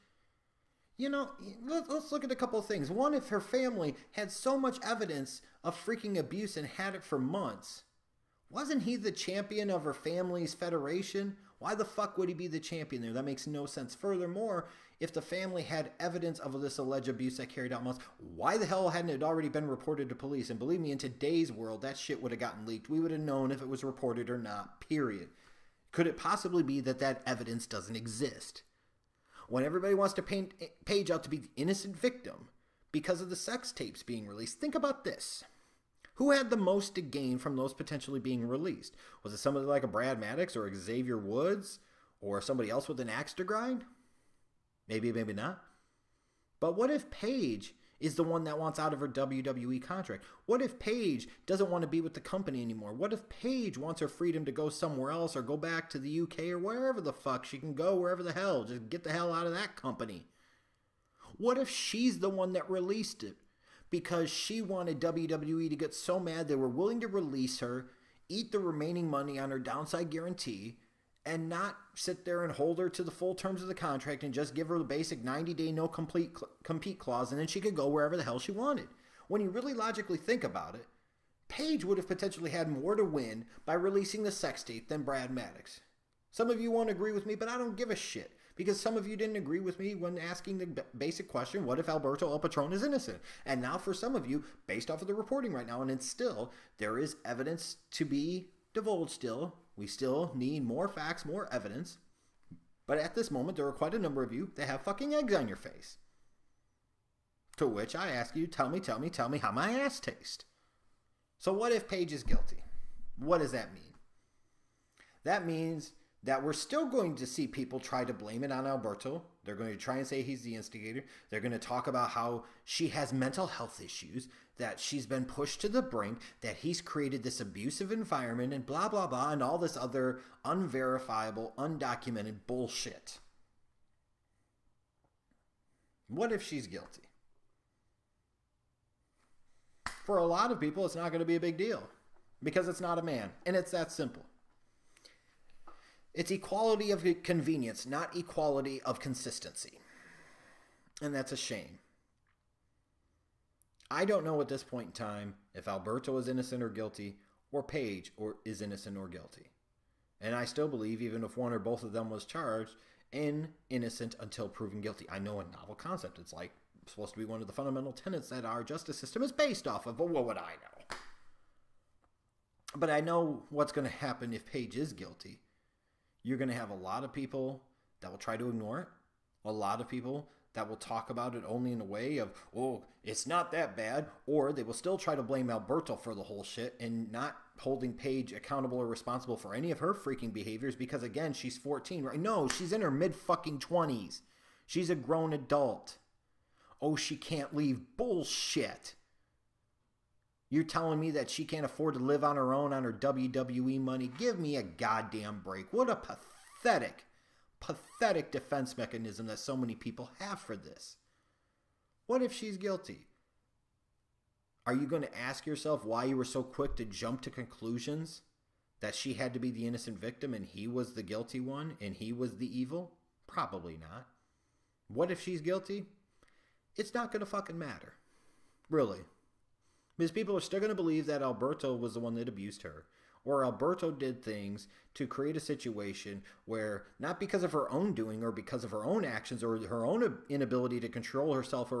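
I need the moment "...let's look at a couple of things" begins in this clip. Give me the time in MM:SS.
00:01.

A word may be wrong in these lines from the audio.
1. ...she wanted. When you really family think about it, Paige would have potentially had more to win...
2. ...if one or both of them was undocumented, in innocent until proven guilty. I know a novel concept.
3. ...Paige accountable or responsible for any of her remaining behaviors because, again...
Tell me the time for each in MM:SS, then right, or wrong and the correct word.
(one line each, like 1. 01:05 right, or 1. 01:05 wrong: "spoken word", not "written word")
1. 01:18 wrong: "logically", not "family"
2. 02:41 wrong: "charged", not "undocumented"
3. 03:07 wrong: "freaking", not "remaining".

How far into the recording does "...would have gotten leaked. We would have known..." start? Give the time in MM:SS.
00:22.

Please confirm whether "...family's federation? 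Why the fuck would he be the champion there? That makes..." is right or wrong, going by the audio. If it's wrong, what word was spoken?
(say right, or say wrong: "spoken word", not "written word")
right.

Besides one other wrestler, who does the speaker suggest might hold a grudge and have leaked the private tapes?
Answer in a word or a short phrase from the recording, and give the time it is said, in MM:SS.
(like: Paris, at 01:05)
Xavier Woods, at 00:40.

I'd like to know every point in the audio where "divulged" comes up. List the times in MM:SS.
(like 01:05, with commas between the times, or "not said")
01:38.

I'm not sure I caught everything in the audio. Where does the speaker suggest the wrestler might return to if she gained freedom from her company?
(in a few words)
the UK.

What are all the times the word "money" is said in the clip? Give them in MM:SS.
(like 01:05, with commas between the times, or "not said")
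01:09, 03:23.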